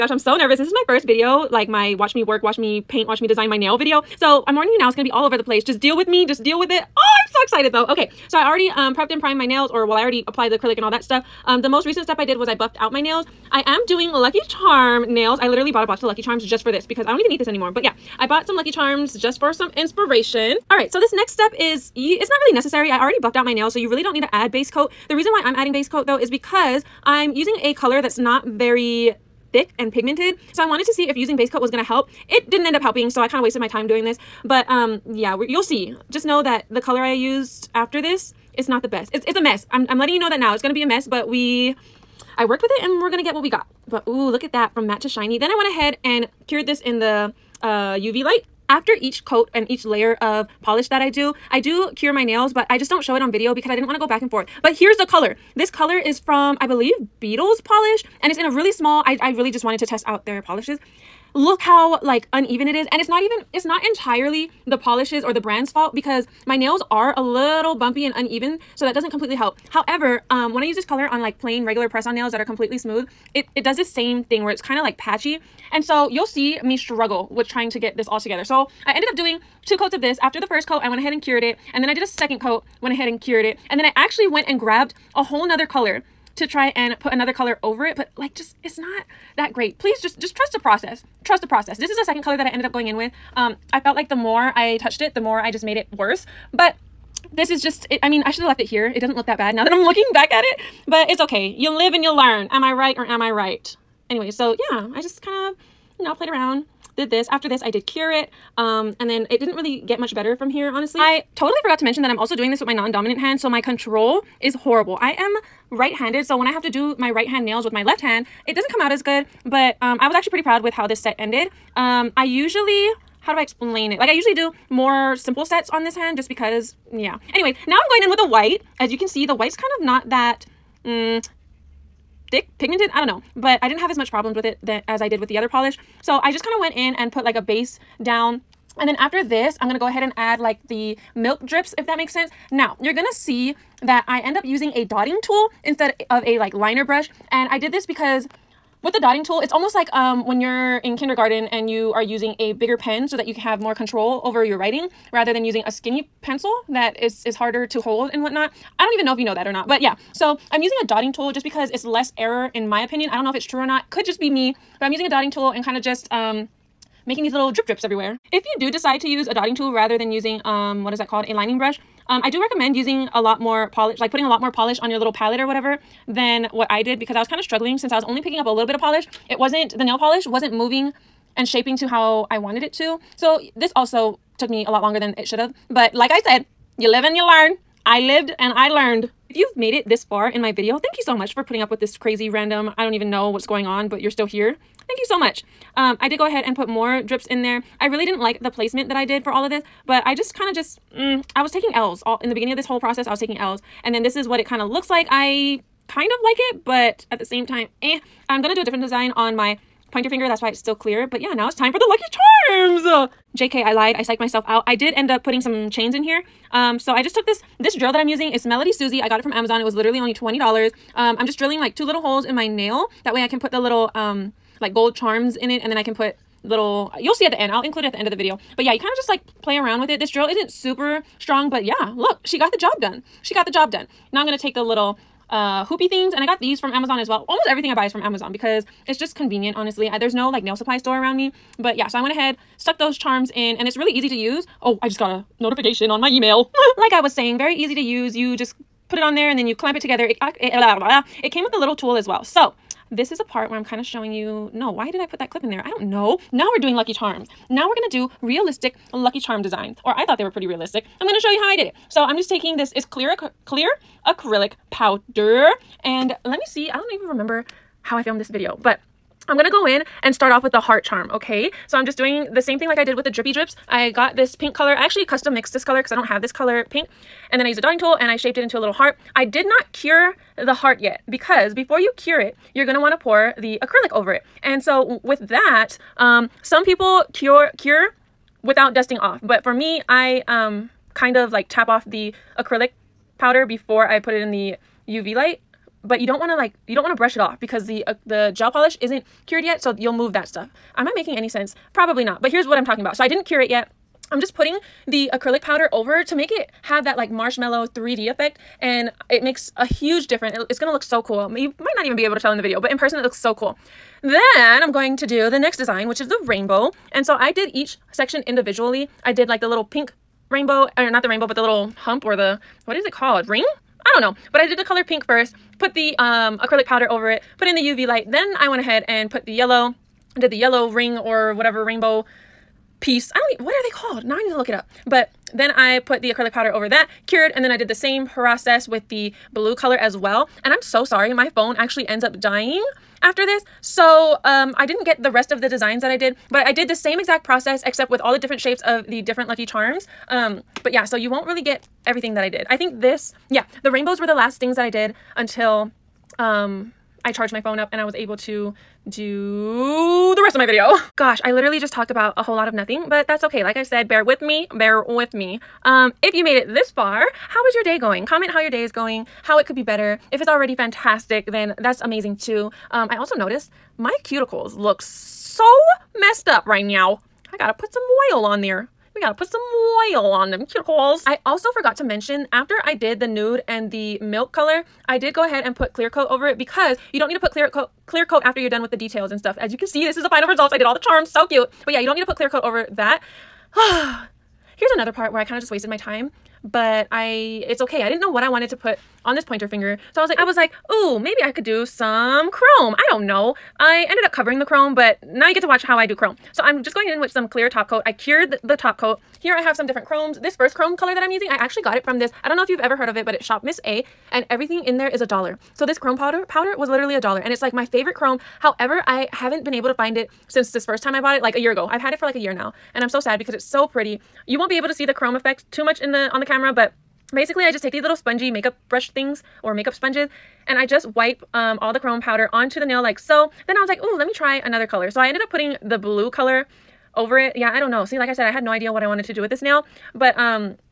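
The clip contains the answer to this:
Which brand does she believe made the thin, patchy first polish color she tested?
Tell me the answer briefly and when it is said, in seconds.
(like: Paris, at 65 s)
Beetles, at 57 s.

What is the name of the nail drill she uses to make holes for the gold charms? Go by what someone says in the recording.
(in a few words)
Melody Susie.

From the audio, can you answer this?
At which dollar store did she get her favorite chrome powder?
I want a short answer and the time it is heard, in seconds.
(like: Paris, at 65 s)
Shop Miss A, at 413 s.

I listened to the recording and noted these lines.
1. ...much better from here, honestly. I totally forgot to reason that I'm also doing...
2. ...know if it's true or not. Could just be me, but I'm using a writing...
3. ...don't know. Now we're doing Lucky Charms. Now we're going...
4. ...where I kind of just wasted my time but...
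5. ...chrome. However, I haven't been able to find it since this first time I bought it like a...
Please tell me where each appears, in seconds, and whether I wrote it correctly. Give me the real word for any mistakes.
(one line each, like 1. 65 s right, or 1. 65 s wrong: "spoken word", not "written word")
1. 109 s wrong: "mention", not "reason"
2. 163 s wrong: "dotting", not "writing"
3. 255 s right
4. 395 s right
5. 417 s right.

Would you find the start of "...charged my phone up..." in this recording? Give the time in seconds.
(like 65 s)
357 s.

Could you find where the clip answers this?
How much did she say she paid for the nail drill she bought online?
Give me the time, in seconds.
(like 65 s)
220 s.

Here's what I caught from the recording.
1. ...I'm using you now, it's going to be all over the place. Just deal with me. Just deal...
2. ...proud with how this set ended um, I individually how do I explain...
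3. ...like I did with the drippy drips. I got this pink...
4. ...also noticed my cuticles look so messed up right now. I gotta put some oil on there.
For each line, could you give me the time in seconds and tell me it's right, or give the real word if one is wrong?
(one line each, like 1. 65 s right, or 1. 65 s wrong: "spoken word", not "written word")
1. 4 s wrong: "warning", not "using"
2. 120 s wrong: "usually", not "individually"
3. 272 s right
4. 372 s right.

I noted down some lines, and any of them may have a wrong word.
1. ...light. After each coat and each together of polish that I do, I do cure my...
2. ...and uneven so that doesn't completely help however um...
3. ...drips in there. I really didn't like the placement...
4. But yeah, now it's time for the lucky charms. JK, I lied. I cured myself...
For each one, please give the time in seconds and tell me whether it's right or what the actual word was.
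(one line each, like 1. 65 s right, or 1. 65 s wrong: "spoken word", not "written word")
1. 48 s wrong: "layer", not "together"
2. 68 s right
3. 197 s right
4. 211 s wrong: "psyched", not "cured".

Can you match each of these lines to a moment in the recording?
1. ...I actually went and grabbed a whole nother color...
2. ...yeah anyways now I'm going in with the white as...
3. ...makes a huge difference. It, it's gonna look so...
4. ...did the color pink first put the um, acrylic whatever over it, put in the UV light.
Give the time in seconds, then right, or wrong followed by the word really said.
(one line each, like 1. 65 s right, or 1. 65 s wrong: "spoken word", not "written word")
1. 83 s right
2. 126 s right
3. 309 s right
4. 324 s wrong: "powder", not "whatever".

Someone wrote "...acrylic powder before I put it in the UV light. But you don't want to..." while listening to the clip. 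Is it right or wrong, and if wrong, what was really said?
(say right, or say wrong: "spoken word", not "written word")
right.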